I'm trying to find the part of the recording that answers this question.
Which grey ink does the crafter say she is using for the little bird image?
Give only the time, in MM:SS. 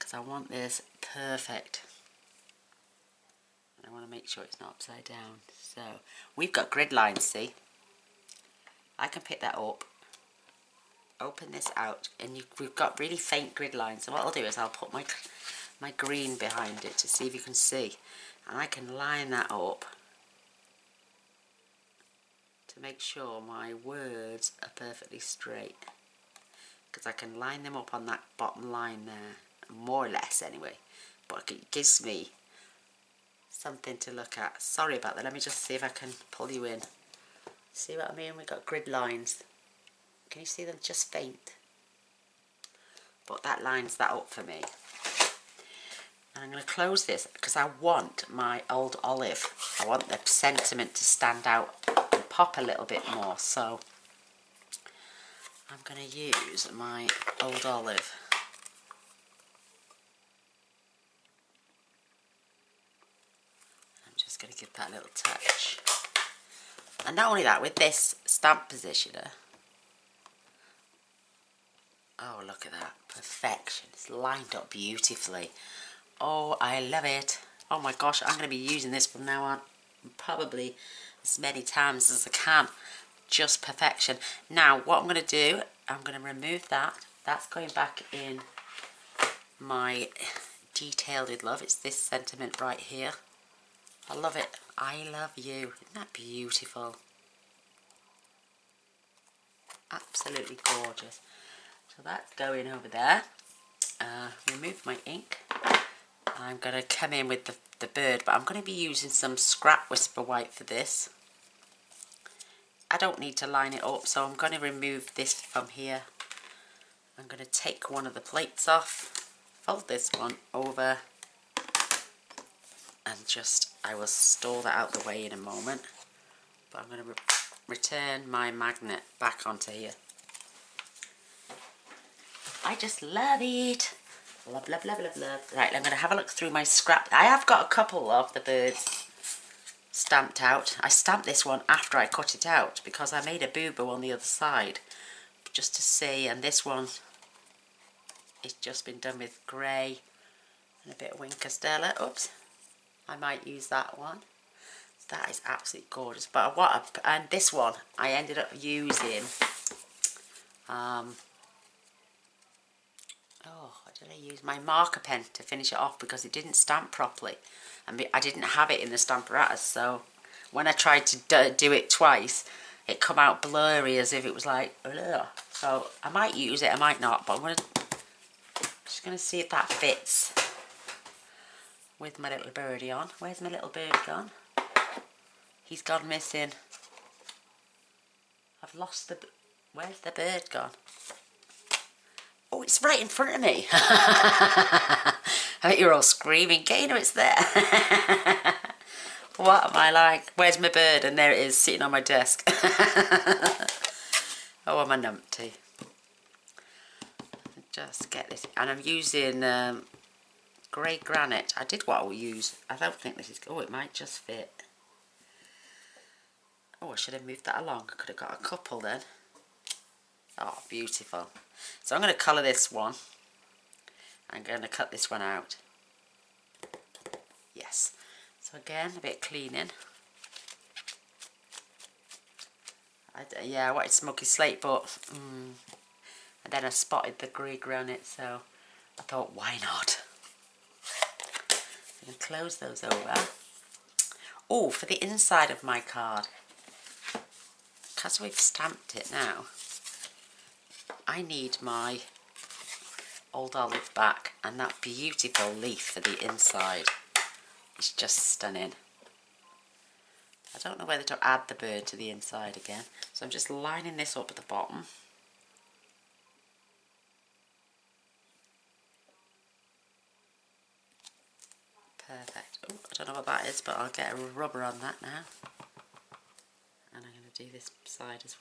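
03:30.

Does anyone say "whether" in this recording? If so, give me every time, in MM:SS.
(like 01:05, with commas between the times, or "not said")
04:20.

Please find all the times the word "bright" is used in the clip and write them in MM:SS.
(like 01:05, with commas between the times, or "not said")
not said.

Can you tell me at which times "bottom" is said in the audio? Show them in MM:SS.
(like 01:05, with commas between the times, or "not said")
00:28, 04:24.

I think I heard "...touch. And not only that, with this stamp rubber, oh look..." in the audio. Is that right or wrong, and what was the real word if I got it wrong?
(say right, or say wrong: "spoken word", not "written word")
wrong: "positioner", not "rubber".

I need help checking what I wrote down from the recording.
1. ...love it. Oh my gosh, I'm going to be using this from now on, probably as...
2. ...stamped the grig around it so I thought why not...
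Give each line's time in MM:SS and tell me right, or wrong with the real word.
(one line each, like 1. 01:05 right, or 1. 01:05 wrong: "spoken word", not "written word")
1. 01:16 right
2. 03:56 wrong: "spotted", not "stamped".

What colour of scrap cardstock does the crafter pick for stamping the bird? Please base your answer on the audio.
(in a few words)
Whisper White.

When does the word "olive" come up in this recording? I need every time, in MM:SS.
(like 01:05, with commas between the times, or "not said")
00:49, 00:57, 04:13.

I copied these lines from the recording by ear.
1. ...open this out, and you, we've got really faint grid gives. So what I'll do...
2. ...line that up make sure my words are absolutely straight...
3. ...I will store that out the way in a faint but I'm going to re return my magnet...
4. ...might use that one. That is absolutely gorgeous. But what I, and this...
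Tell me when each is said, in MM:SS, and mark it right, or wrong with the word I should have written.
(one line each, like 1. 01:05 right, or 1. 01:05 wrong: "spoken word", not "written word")
1. 00:11 wrong: "lines", not "gives"
2. 00:18 wrong: "perfectly", not "absolutely"
3. 02:03 wrong: "moment", not "faint"
4. 02:33 right.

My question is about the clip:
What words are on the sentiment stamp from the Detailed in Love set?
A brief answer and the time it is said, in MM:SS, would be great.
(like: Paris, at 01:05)
I love you, at 01:34.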